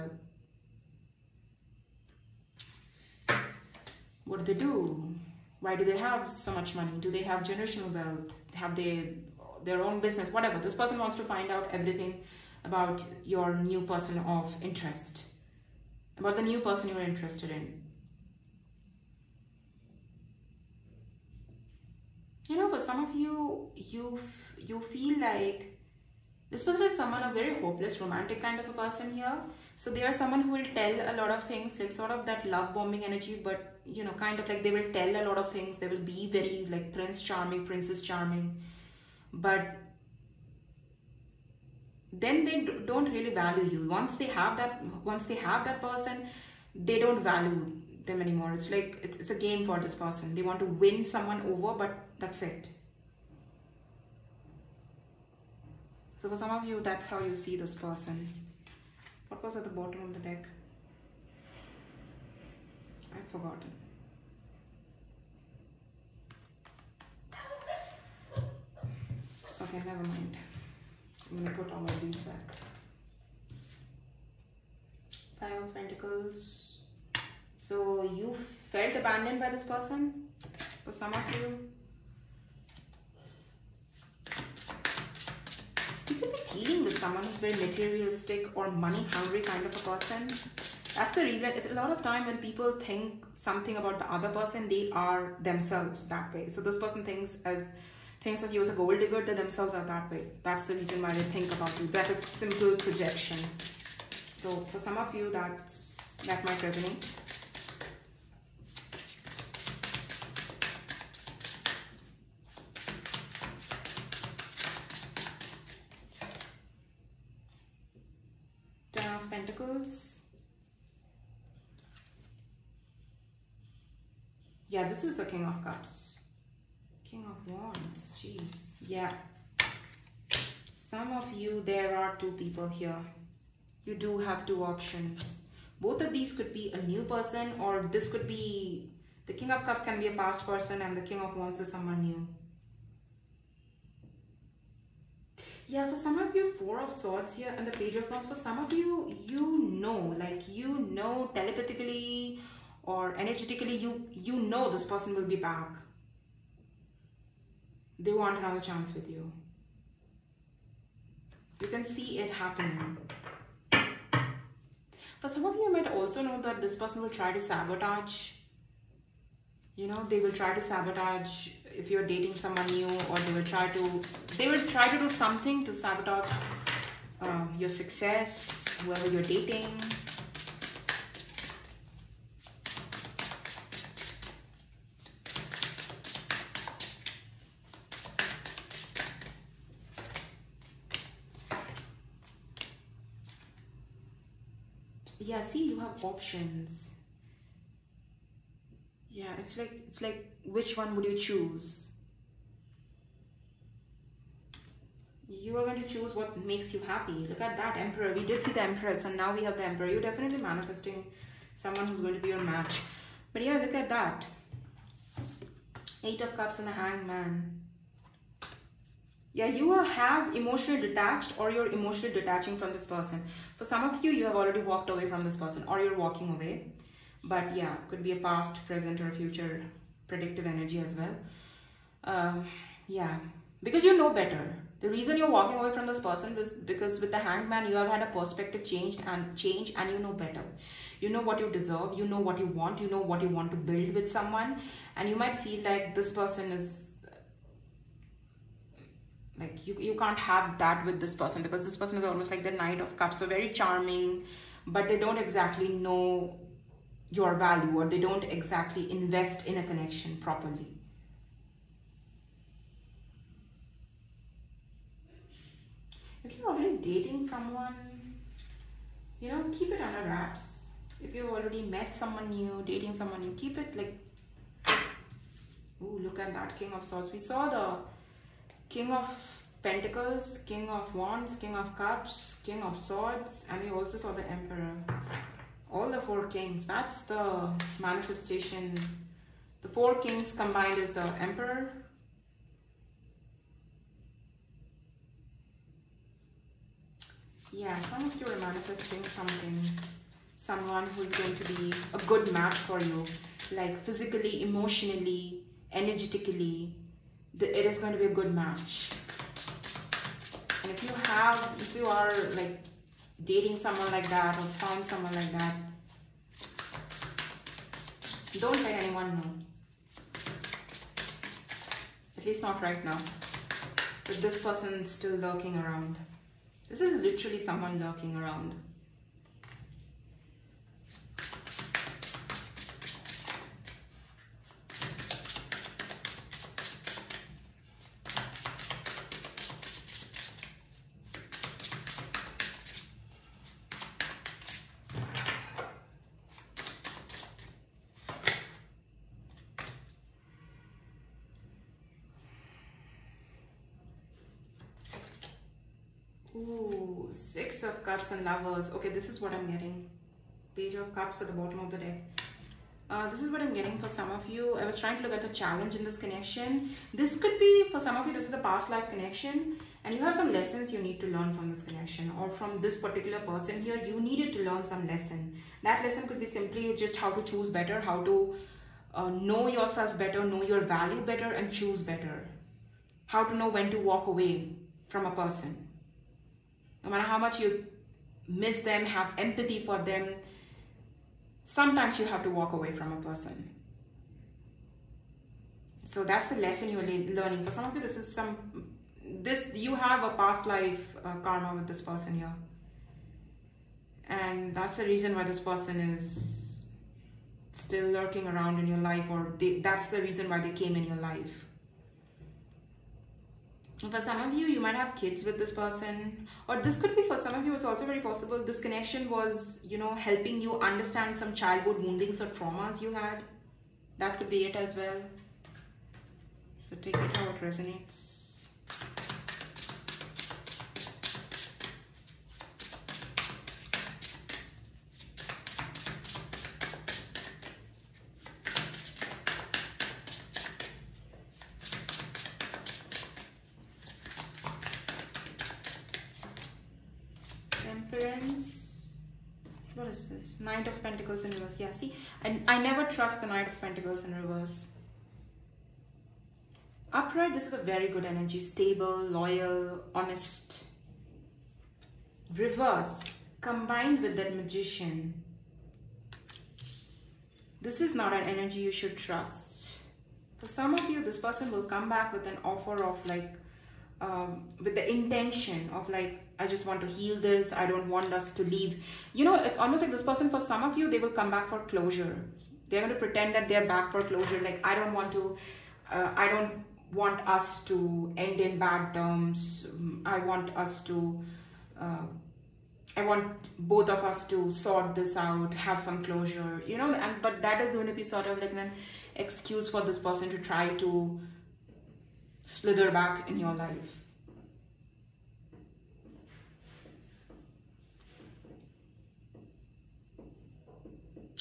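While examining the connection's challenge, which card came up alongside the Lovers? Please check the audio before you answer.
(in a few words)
Six of Cups.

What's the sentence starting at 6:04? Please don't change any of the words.
I was trying to look at the challenge in this connection.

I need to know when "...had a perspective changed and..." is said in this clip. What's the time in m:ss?
3:57.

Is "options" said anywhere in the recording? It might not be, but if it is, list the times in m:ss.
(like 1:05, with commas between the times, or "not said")
2:14, 3:16.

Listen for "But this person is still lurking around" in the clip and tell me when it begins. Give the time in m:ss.
5:24.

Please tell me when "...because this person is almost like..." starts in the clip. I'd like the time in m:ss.
4:11.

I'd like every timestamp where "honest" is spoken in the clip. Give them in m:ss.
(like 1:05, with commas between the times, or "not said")
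7:39.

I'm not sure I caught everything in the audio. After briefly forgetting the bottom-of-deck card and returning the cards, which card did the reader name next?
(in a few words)
Five of Pentacles.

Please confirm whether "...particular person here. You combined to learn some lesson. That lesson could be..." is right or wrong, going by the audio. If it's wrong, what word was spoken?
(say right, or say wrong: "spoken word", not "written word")
wrong: "needed", not "combined".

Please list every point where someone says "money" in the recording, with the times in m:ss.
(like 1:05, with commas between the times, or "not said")
0:06, 1:28.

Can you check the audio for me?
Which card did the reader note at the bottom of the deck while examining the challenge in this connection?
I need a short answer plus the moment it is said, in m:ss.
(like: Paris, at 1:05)
Page of Cups, at 6:00.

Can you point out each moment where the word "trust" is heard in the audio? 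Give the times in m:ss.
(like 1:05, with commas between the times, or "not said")
7:32, 7:48.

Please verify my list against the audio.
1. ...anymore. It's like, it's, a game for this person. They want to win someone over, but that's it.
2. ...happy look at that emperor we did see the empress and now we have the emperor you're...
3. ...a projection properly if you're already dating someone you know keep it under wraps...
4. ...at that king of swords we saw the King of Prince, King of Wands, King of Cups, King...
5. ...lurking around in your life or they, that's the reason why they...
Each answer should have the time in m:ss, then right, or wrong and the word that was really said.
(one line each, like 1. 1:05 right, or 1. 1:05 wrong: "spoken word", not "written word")
1. 0:48 right
2. 3:26 right
3. 4:19 wrong: "connection", not "projection"
4. 4:36 wrong: "Pentacles", not "Prince"
5. 6:47 right.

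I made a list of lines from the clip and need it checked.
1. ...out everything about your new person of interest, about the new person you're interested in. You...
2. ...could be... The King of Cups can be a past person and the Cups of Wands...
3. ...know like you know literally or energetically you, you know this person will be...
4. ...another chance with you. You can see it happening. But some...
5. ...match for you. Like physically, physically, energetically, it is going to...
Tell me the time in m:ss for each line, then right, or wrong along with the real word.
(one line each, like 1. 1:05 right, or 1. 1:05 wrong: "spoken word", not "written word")
1. 0:11 right
2. 2:18 wrong: "King", not "Cups"
3. 2:29 wrong: "telepathically", not "literally"
4. 2:38 right
5. 5:02 wrong: "emotionally", not "physically".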